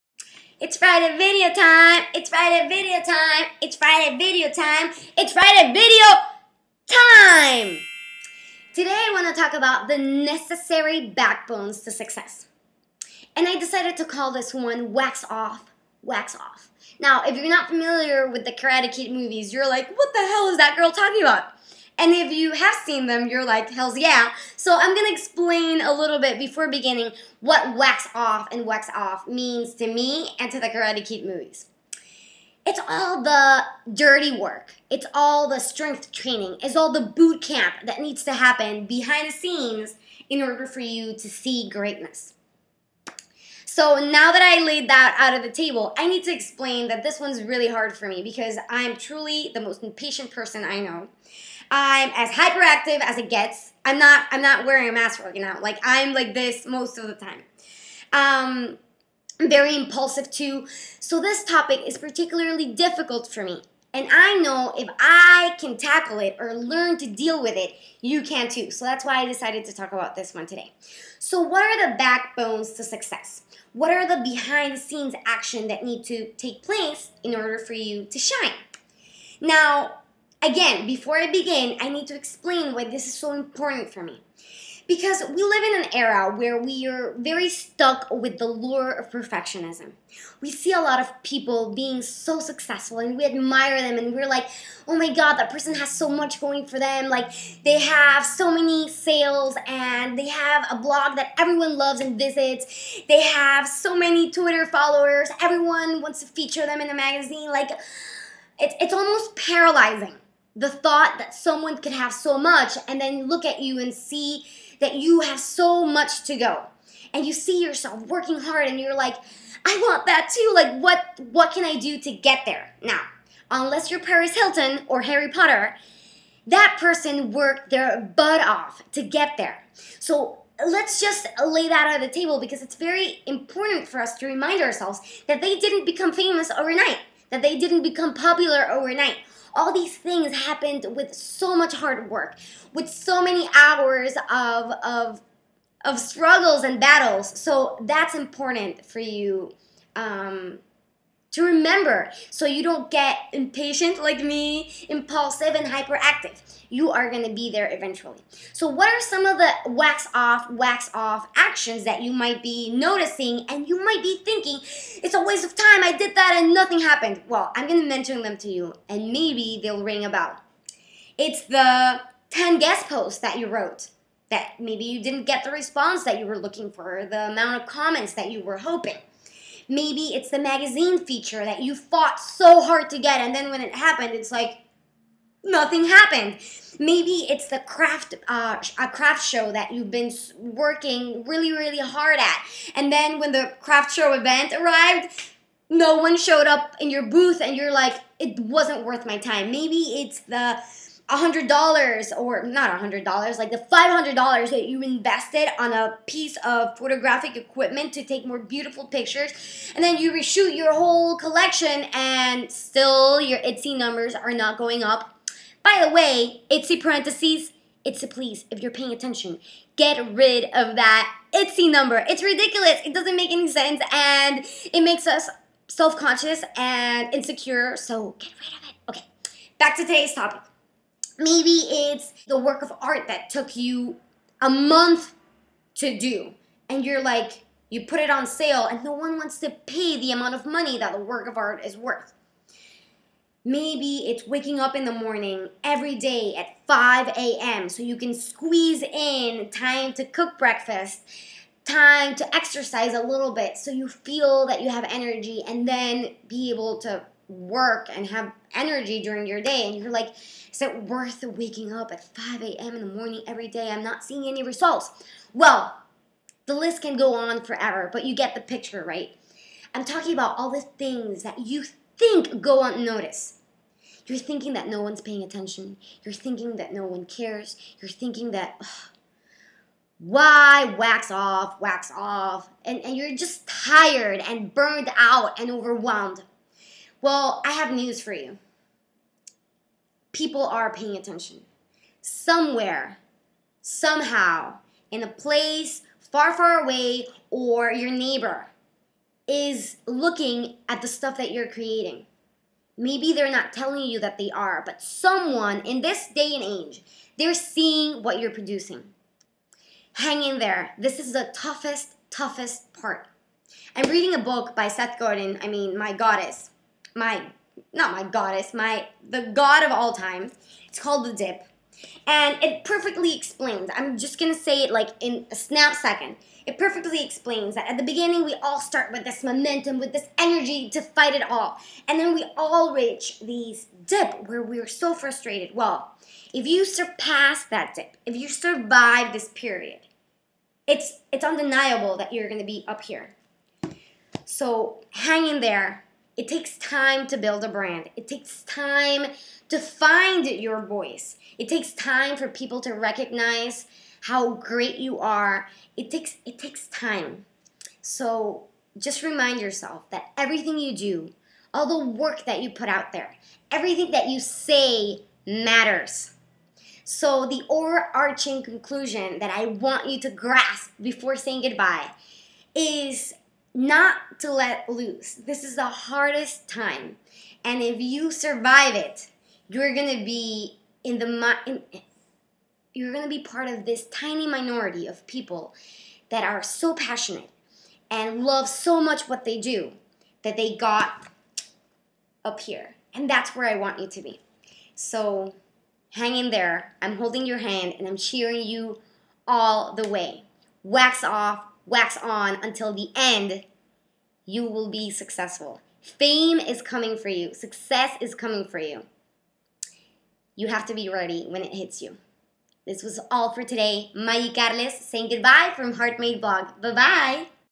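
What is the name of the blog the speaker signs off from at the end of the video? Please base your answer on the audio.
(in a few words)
Heart Made Blog.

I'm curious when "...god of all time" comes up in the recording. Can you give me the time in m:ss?
5:19.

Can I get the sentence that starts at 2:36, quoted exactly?
You are going to be there eventually.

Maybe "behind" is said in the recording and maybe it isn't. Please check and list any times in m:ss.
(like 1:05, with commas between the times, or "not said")
0:38, 1:14.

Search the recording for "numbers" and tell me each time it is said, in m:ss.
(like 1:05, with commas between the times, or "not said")
3:33, 3:41.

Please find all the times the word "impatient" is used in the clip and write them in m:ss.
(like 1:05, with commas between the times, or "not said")
0:49, 2:33.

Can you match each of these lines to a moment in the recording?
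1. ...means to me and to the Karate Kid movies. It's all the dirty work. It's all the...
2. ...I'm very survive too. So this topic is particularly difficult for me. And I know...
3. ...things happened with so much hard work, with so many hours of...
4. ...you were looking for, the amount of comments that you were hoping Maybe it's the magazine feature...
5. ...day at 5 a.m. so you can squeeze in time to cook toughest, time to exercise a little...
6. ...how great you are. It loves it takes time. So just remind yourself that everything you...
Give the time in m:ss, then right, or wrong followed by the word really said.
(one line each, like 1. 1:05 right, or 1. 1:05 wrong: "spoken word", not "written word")
1. 0:29 right
2. 0:59 wrong: "impulsive", not "survive"
3. 2:19 right
4. 2:56 right
5. 4:05 wrong: "breakfast", not "toughest"
6. 5:54 wrong: "takes", not "loves".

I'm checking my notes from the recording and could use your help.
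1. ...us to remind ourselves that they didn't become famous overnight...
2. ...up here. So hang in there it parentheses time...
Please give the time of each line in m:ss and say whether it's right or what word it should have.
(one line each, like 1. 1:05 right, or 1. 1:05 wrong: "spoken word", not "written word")
1. 2:14 right
2. 5:42 wrong: "takes", not "parentheses".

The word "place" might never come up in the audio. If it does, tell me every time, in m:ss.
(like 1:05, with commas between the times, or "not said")
1:16, 4:55.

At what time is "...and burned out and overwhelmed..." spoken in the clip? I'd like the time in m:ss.
4:44.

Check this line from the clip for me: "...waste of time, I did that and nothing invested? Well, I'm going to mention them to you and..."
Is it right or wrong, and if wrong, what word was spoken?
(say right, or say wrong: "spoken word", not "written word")
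wrong: "happened", not "invested".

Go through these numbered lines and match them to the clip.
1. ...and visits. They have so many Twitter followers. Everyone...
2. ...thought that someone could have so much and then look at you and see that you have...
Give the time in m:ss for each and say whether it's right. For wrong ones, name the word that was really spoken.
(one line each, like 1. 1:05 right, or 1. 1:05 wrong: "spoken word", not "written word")
1. 1:42 right
2. 1:50 right.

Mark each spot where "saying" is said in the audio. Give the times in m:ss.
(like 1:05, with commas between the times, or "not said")
6:11, 6:54.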